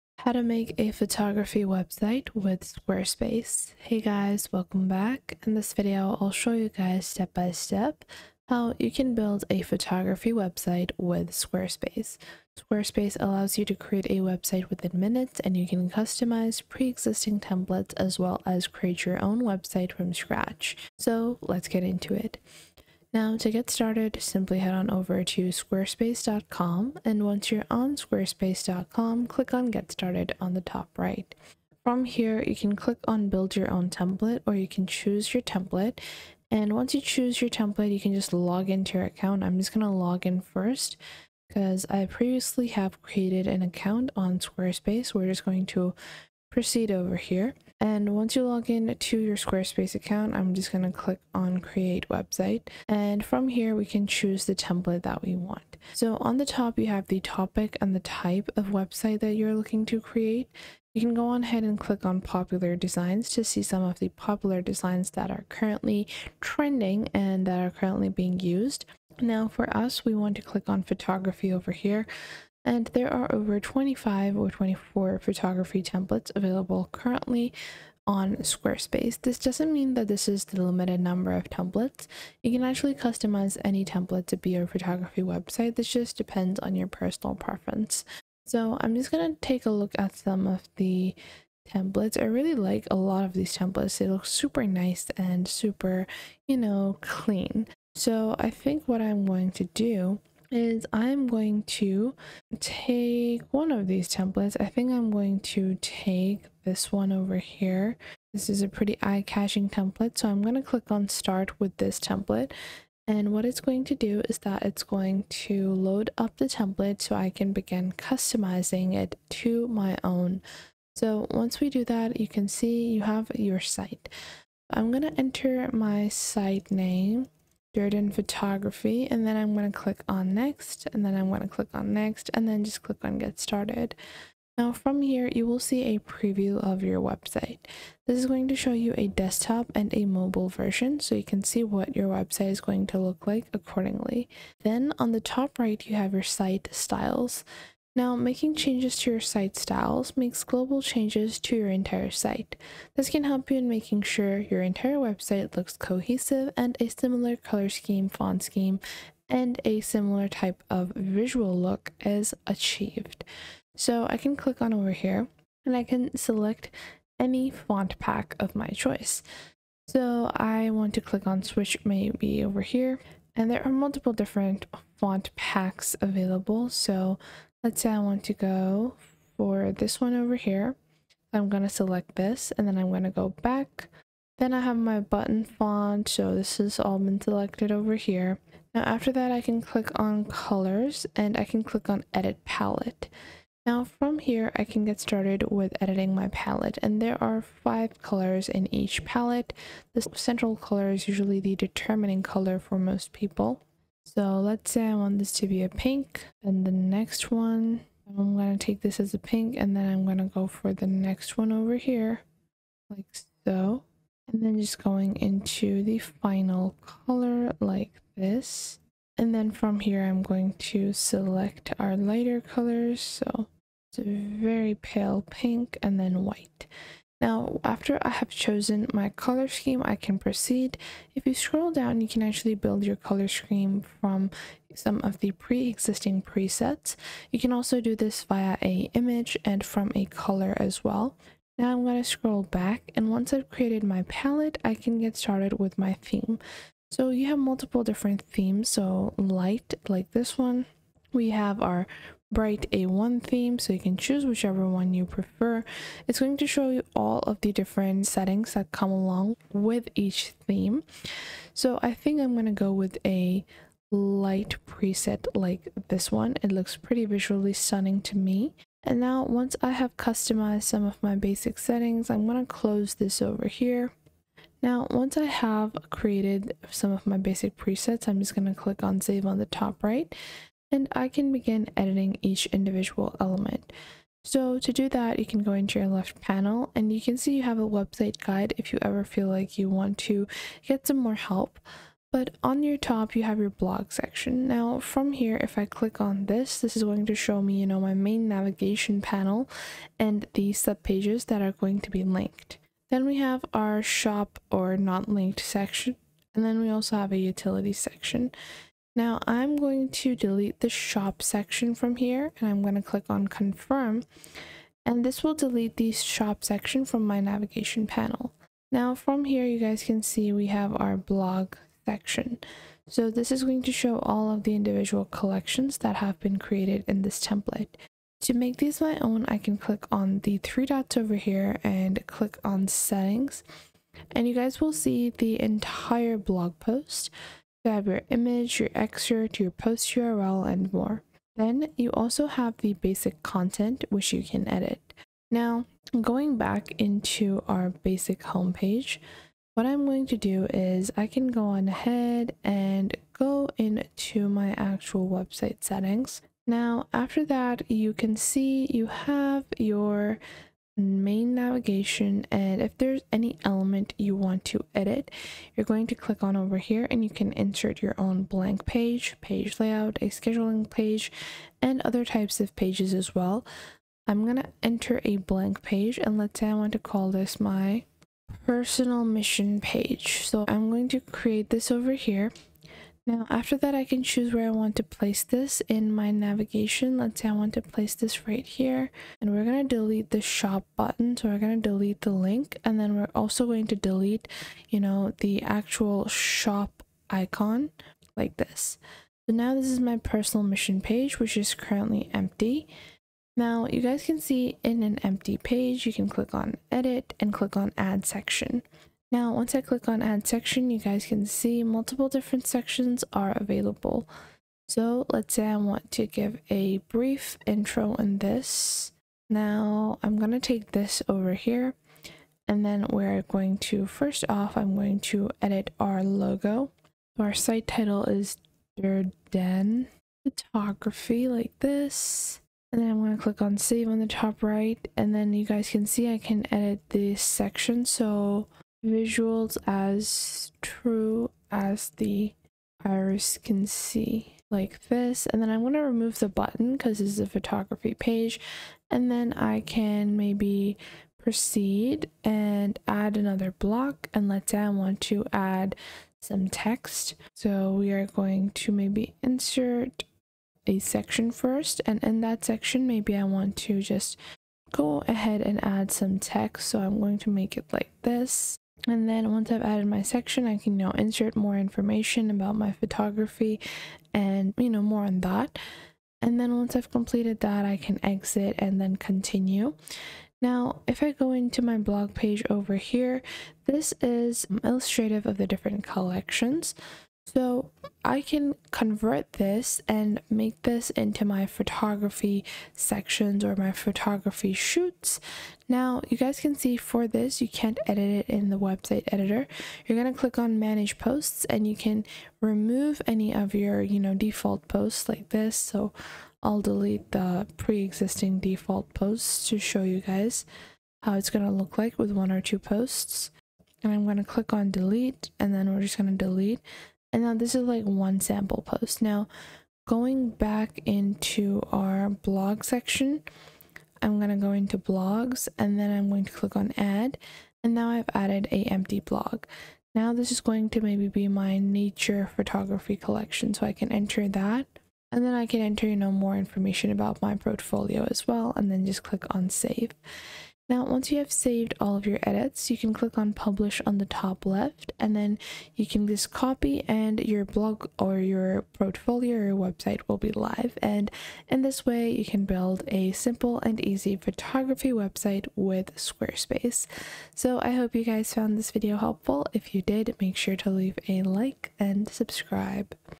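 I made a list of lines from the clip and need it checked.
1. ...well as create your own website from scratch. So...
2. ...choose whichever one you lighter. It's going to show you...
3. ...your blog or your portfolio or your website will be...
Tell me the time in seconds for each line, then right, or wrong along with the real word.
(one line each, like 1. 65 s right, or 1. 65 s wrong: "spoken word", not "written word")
1. 18 s right
2. 253 s wrong: "prefer", not "lighter"
3. 547 s right.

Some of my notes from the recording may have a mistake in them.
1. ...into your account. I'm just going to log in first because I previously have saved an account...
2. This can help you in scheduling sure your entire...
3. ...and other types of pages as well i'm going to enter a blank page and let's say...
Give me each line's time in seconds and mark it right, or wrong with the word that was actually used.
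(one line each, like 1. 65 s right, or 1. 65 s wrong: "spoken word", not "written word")
1. 38 s wrong: "created", not "saved"
2. 152 s wrong: "making", not "scheduling"
3. 371 s right.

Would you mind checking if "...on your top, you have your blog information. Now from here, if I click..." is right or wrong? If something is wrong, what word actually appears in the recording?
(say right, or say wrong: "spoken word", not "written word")
wrong: "section", not "information".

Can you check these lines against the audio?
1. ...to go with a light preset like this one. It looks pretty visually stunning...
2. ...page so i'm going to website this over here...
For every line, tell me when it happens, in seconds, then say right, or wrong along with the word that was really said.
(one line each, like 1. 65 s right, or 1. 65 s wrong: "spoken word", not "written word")
1. 262 s right
2. 379 s wrong: "create", not "website".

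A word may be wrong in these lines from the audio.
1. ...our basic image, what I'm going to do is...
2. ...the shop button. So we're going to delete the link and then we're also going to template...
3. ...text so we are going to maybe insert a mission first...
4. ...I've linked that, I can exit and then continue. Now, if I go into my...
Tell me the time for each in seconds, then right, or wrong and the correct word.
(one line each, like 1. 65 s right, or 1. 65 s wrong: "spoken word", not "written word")
1. 347 s wrong: "homepage", not "image"
2. 390 s wrong: "delete", not "template"
3. 456 s wrong: "section", not "mission"
4. 476 s wrong: "completed", not "linked".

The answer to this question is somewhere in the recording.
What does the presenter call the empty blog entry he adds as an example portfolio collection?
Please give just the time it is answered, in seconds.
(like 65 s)
531 s.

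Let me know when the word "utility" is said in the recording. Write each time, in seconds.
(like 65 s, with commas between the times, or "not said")
307 s.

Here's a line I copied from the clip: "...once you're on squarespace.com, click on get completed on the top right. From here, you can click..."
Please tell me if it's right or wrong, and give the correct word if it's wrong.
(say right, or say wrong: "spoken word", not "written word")
wrong: "started", not "completed".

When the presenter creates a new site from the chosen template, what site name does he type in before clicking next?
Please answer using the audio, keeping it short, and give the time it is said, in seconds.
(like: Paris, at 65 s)
Jordan Photography, at 127 s.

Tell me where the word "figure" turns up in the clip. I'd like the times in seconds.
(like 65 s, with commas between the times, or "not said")
not said.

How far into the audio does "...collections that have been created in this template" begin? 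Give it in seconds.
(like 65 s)
325 s.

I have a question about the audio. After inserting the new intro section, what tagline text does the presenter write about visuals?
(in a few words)
visuals as true as the iris can see.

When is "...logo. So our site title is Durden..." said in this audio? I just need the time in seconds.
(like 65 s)
426 s.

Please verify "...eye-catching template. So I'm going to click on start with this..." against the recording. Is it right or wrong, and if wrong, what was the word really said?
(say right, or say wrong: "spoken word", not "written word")
right.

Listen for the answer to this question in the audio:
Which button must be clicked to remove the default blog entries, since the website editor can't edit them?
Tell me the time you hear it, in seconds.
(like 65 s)
500 s.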